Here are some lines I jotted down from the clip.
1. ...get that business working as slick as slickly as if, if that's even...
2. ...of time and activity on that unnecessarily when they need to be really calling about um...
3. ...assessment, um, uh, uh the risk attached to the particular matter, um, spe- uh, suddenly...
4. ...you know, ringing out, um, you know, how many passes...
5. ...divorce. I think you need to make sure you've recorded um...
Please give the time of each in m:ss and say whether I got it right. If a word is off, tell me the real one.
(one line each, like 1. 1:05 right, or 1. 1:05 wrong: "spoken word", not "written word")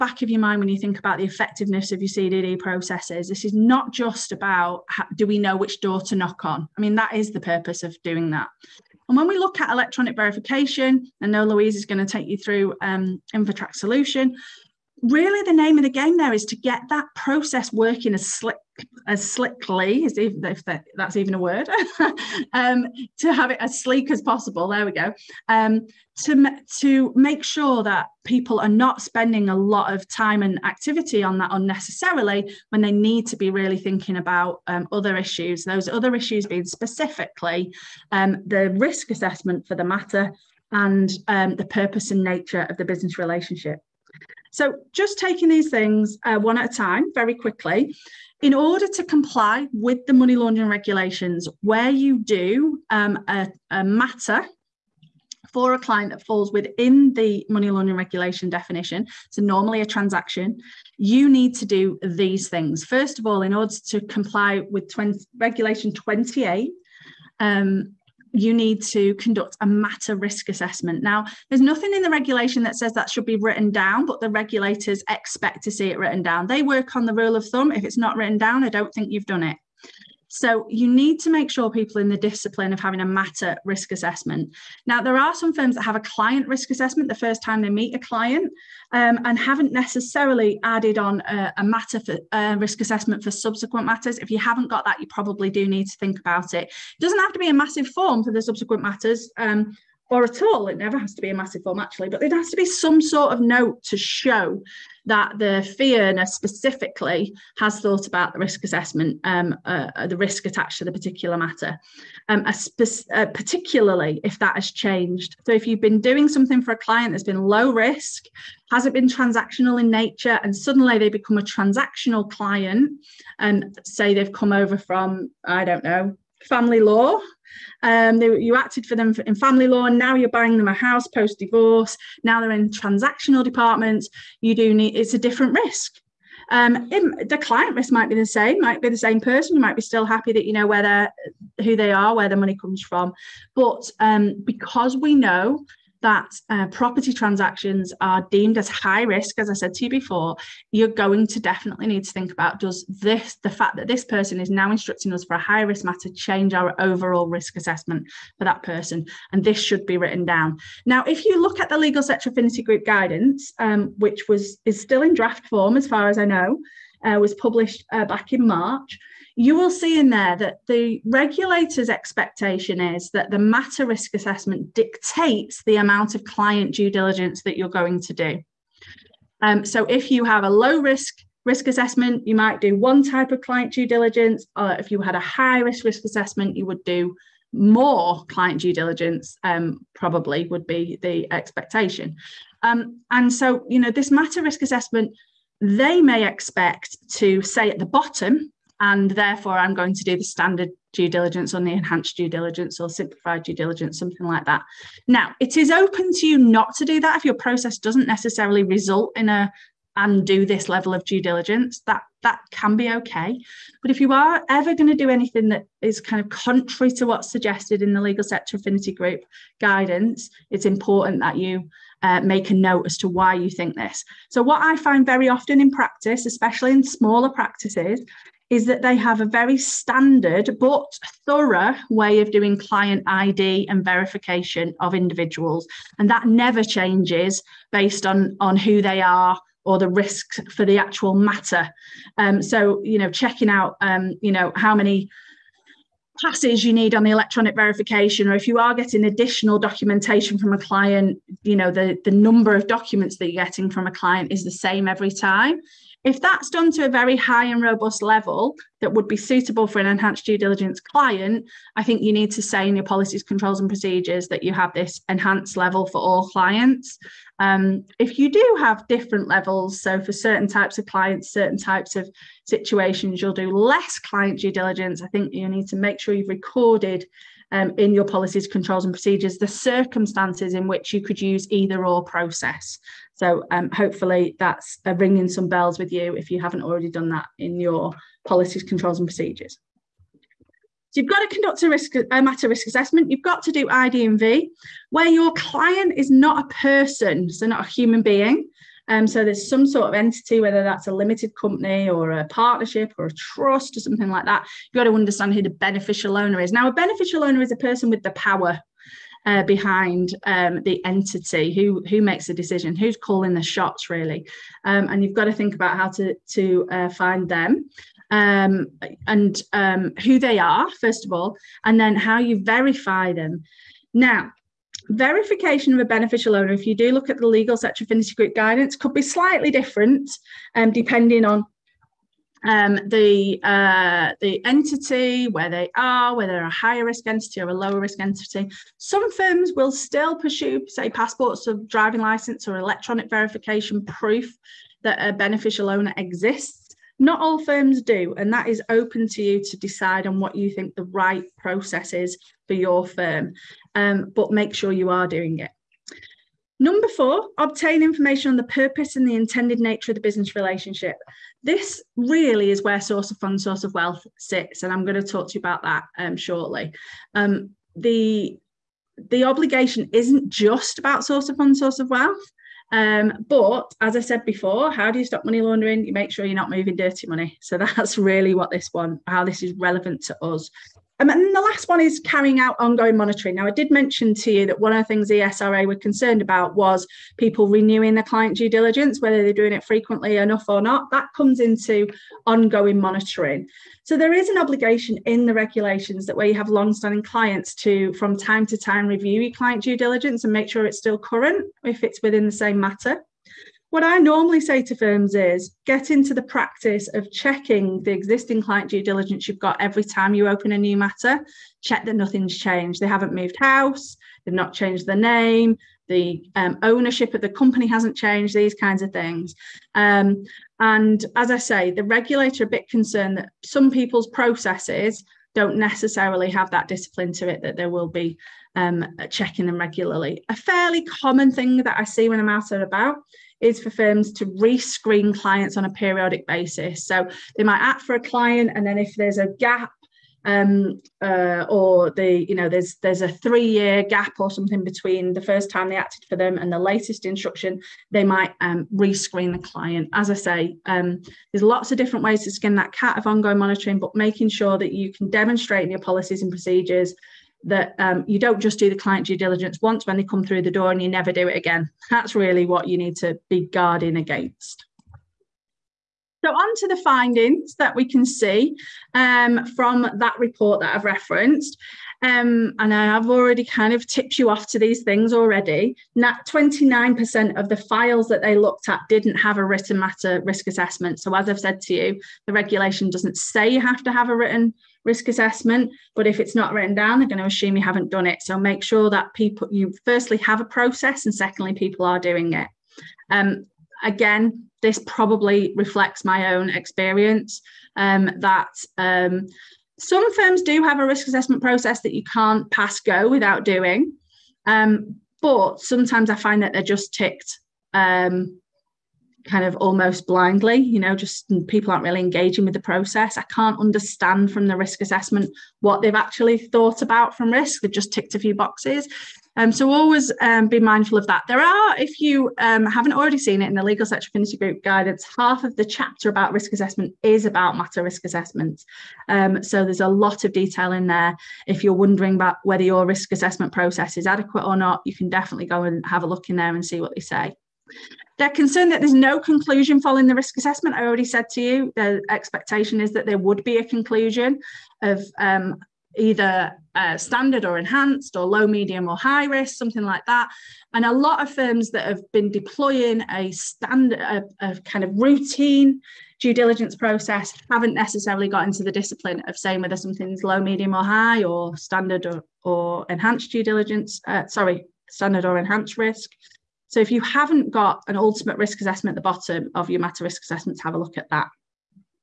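1. 0:16 wrong: "process", not "business"
2. 0:29 wrong: "thinking", not "calling"
3. 1:48 wrong: "particularly", not "suddenly"
4. 4:02 wrong: "checking", not "ringing"
5. 4:34 wrong: "diligence", not "divorce".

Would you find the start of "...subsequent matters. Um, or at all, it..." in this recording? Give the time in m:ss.
1:38.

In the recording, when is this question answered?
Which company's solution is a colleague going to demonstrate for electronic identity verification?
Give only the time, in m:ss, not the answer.
0:13.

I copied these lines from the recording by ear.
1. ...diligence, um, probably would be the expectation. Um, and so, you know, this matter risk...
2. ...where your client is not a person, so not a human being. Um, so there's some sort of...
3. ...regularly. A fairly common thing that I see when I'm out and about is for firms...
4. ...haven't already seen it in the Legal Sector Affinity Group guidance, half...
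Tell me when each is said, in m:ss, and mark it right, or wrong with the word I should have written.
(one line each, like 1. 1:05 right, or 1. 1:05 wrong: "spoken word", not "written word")
1. 3:08 right
2. 4:54 right
3. 7:09 right
4. 8:42 right.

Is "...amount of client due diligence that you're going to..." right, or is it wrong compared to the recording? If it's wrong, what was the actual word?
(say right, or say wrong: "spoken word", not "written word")
right.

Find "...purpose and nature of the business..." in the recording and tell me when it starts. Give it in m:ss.
0:41.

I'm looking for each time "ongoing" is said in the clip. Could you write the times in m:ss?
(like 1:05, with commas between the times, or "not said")
6:22, 6:32, 7:33.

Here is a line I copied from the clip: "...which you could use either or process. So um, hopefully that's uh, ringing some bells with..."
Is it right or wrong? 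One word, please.
right.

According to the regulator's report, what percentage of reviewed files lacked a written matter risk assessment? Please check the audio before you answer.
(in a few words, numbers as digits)
29%.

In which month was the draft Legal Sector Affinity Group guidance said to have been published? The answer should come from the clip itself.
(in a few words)
March.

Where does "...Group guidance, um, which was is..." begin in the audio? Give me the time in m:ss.
2:42.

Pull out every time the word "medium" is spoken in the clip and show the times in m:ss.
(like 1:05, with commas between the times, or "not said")
9:08, 9:20.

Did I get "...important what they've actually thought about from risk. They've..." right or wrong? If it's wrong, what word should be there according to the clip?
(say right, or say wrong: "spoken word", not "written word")
wrong: "assessment", not "important".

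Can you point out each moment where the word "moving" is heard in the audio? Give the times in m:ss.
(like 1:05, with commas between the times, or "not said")
6:16.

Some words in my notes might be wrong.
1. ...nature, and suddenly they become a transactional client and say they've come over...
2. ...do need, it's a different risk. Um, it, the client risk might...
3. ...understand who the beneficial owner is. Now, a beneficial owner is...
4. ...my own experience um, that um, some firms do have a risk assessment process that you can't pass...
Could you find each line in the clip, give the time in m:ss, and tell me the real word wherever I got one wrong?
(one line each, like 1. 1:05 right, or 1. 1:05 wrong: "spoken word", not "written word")
1. 1:59 right
2. 2:14 right
3. 5:04 right
4. 8:16 right.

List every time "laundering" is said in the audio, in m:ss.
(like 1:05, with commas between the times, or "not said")
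0:50, 0:57, 6:15.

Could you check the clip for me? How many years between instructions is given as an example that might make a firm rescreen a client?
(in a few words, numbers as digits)
3.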